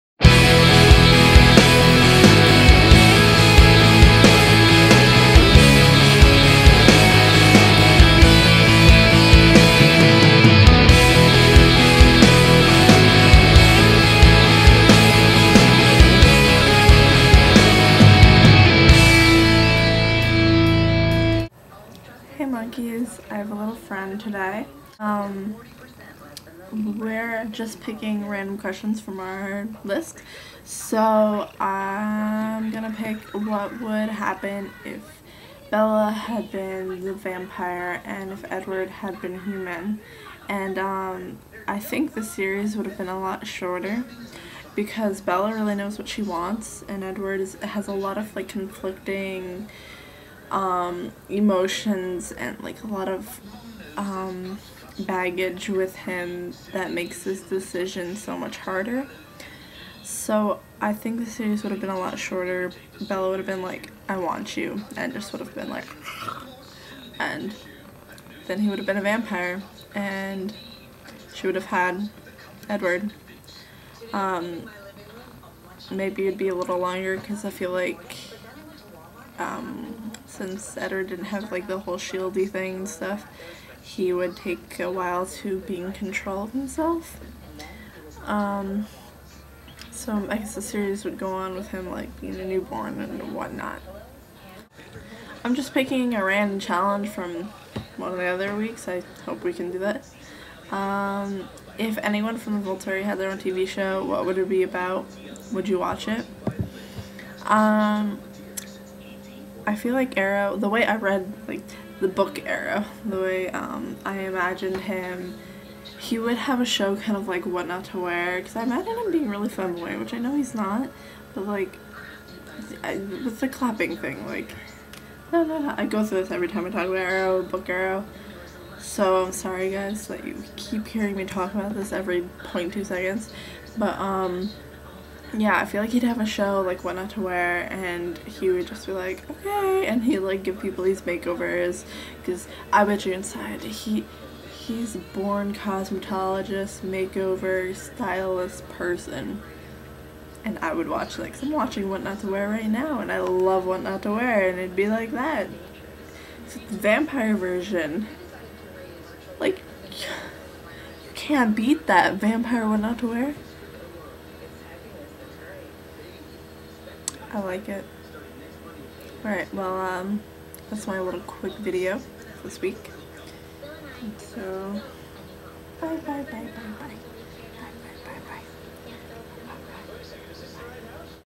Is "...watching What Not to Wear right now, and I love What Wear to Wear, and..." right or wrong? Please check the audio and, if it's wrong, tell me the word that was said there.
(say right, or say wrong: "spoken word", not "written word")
wrong: "Not", not "Wear".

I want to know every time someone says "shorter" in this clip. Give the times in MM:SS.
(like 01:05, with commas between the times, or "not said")
00:43, 01:02.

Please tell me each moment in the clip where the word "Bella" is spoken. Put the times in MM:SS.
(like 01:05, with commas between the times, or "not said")
00:35, 00:45, 01:03.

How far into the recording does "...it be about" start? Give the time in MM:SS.
01:44.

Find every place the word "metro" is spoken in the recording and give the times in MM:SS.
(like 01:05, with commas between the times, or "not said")
not said.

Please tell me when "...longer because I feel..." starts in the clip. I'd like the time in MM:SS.
01:16.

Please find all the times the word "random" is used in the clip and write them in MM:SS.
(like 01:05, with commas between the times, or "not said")
00:28, 01:36.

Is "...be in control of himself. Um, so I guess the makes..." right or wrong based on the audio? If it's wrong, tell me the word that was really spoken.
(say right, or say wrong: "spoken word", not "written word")
wrong: "series", not "makes".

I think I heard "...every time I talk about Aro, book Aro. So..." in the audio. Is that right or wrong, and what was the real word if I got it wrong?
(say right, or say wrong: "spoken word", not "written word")
right.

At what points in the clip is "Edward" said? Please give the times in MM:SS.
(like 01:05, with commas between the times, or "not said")
00:38, 00:47, 01:12, 01:20.